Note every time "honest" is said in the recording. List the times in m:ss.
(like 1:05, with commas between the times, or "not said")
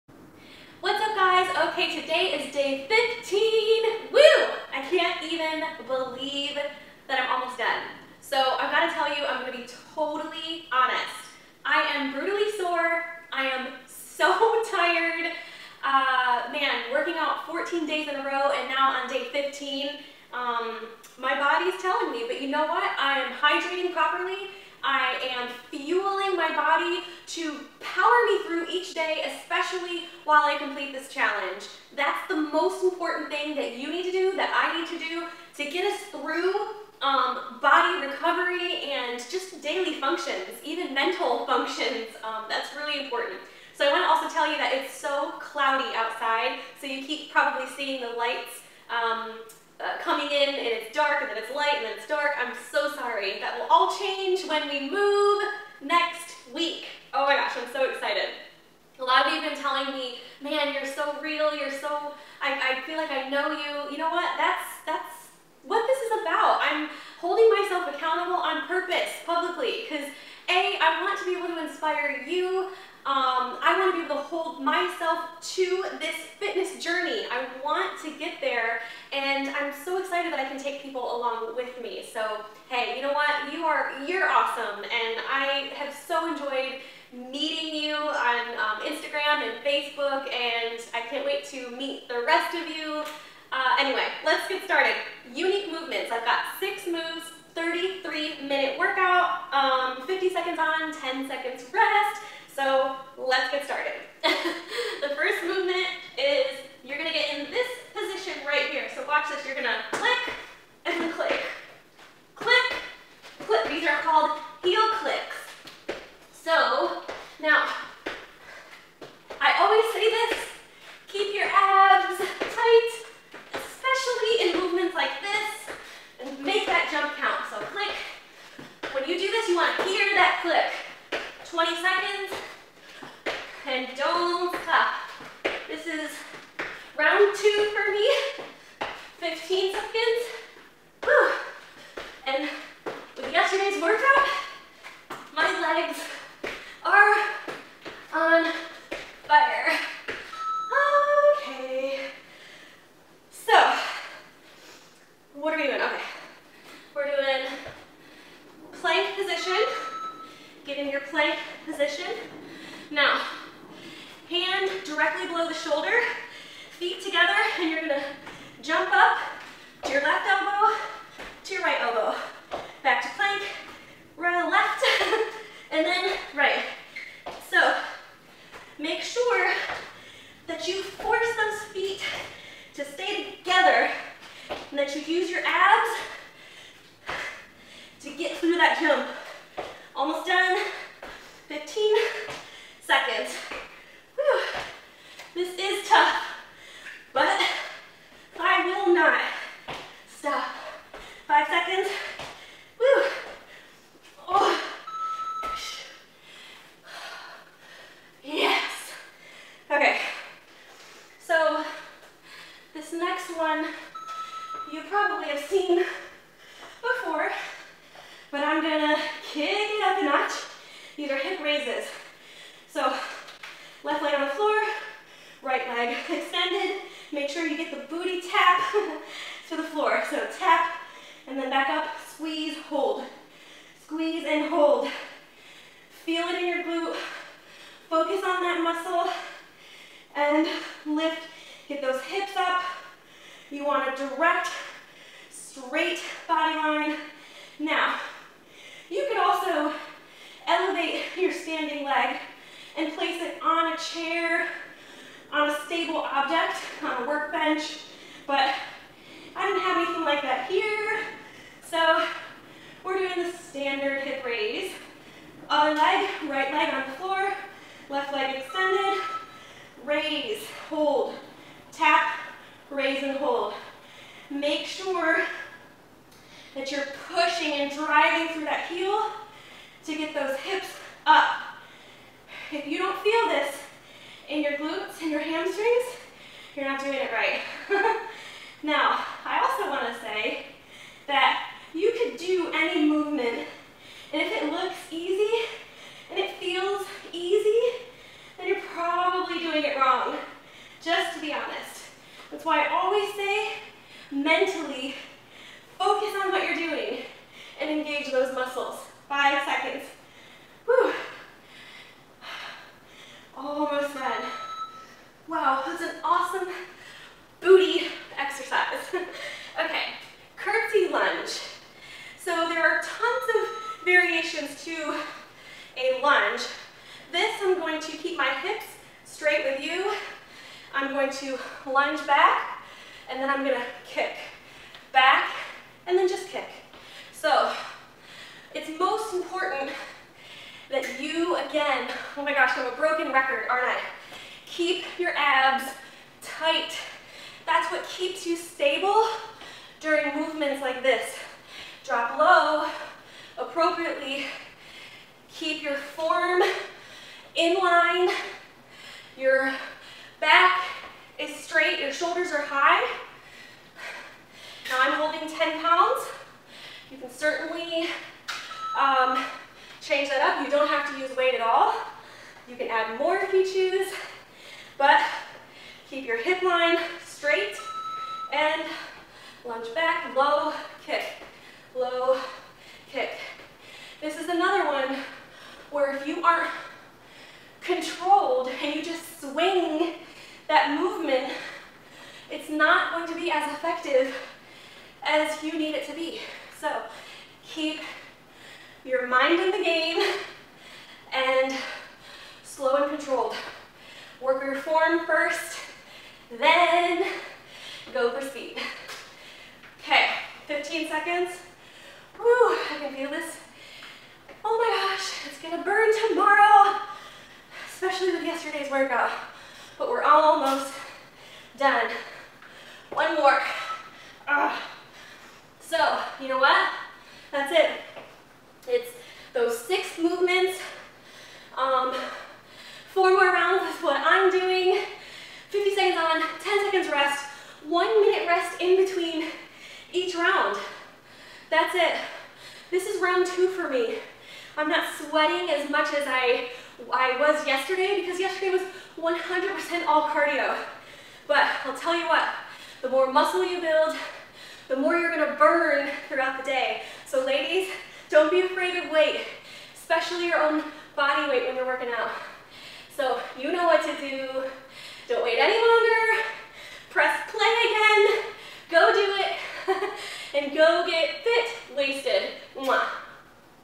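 0:10, 5:01.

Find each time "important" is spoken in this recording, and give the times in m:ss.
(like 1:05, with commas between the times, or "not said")
0:32, 0:43, 5:39.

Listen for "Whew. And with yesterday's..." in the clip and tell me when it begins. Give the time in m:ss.
2:21.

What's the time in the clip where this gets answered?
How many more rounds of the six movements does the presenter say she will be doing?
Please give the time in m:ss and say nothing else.
7:12.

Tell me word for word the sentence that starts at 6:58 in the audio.
yesterday's workout, but we're almost done.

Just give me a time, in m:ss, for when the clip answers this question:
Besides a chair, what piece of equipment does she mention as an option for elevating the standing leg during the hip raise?
4:17.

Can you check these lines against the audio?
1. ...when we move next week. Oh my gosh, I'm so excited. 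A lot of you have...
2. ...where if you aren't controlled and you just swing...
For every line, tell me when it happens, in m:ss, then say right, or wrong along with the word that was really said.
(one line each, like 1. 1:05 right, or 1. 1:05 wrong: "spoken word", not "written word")
1. 0:54 right
2. 6:25 right.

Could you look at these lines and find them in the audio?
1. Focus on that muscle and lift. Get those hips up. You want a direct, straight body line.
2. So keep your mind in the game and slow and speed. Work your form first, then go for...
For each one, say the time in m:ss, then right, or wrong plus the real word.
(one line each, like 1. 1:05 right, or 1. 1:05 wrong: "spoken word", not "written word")
1. 3:57 right
2. 6:36 wrong: "controlled", not "speed".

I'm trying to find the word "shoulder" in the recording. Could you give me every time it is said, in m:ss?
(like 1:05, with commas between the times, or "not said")
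2:45, 6:01.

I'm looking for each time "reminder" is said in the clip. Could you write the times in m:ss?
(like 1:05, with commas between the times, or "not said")
not said.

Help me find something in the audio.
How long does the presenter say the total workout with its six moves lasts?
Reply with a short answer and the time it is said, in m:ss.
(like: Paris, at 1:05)
33 minutes, at 1:37.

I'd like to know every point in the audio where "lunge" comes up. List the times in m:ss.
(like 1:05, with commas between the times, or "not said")
5:31, 6:19.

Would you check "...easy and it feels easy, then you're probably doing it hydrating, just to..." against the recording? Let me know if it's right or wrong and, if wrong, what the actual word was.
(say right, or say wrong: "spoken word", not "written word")
wrong: "wrong", not "hydrating".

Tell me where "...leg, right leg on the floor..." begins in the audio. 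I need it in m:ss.
4:25.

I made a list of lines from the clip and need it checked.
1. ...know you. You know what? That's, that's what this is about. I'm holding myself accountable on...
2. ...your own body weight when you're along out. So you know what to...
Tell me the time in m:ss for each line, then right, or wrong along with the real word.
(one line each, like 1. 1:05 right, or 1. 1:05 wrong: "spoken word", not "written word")
1. 1:03 right
2. 7:40 wrong: "working", not "along".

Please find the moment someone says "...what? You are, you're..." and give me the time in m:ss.
1:23.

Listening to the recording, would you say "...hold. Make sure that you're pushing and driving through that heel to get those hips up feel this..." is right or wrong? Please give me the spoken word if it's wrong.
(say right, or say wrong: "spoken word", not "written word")
right.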